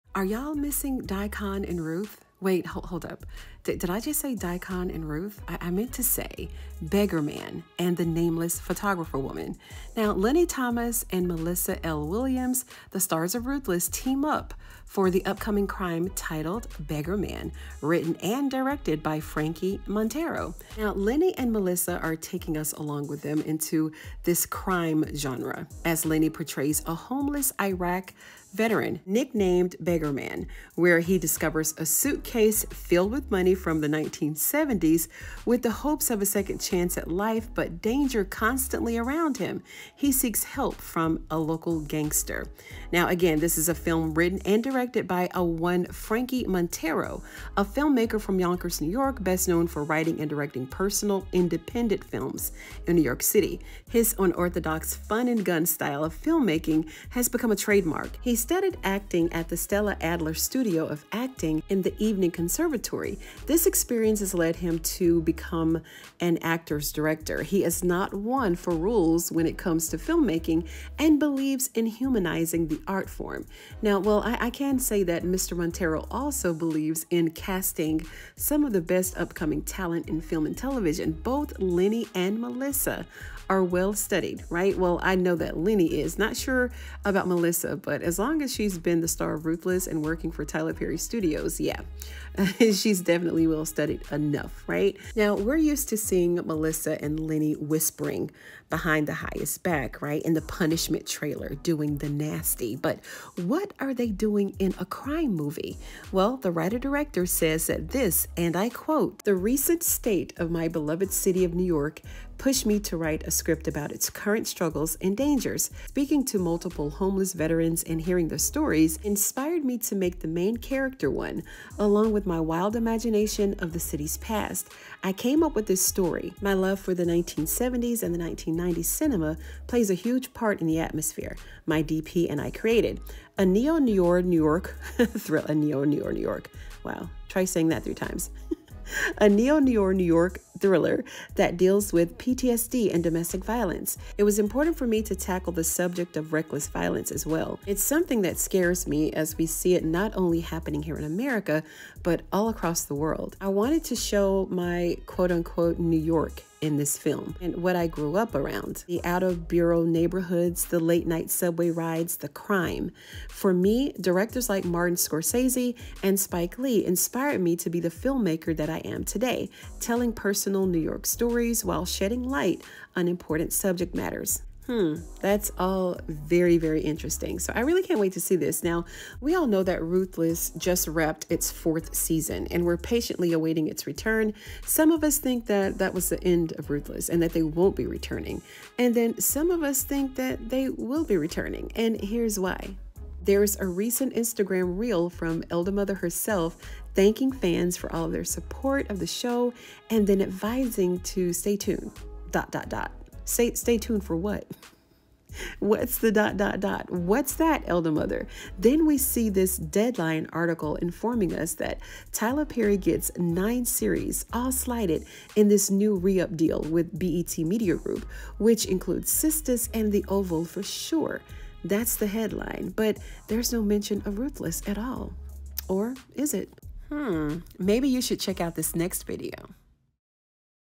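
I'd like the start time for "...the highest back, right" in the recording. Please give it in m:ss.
1:39.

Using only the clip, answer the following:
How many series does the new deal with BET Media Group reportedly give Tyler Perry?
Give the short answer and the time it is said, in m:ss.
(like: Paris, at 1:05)
9, at 3:33.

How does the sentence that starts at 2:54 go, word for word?
Hmm, that's all very, very interesting.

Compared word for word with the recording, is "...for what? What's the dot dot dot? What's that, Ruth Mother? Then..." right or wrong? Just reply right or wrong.
wrong.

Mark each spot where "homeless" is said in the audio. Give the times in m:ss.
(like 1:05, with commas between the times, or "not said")
0:26, 1:56.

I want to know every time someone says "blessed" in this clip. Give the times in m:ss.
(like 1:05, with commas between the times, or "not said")
not said.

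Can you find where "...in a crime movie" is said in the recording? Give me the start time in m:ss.
1:44.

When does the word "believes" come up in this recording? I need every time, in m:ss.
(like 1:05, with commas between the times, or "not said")
1:11, 1:16.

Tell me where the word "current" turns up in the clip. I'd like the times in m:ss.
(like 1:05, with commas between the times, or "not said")
1:54.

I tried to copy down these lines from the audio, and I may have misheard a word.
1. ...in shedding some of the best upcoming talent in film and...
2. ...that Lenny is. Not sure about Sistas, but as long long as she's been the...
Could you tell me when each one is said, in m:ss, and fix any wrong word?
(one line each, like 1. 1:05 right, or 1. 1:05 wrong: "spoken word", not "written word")
1. 1:17 wrong: "casting", not "shedding"
2. 1:25 wrong: "Melissa", not "Sistas".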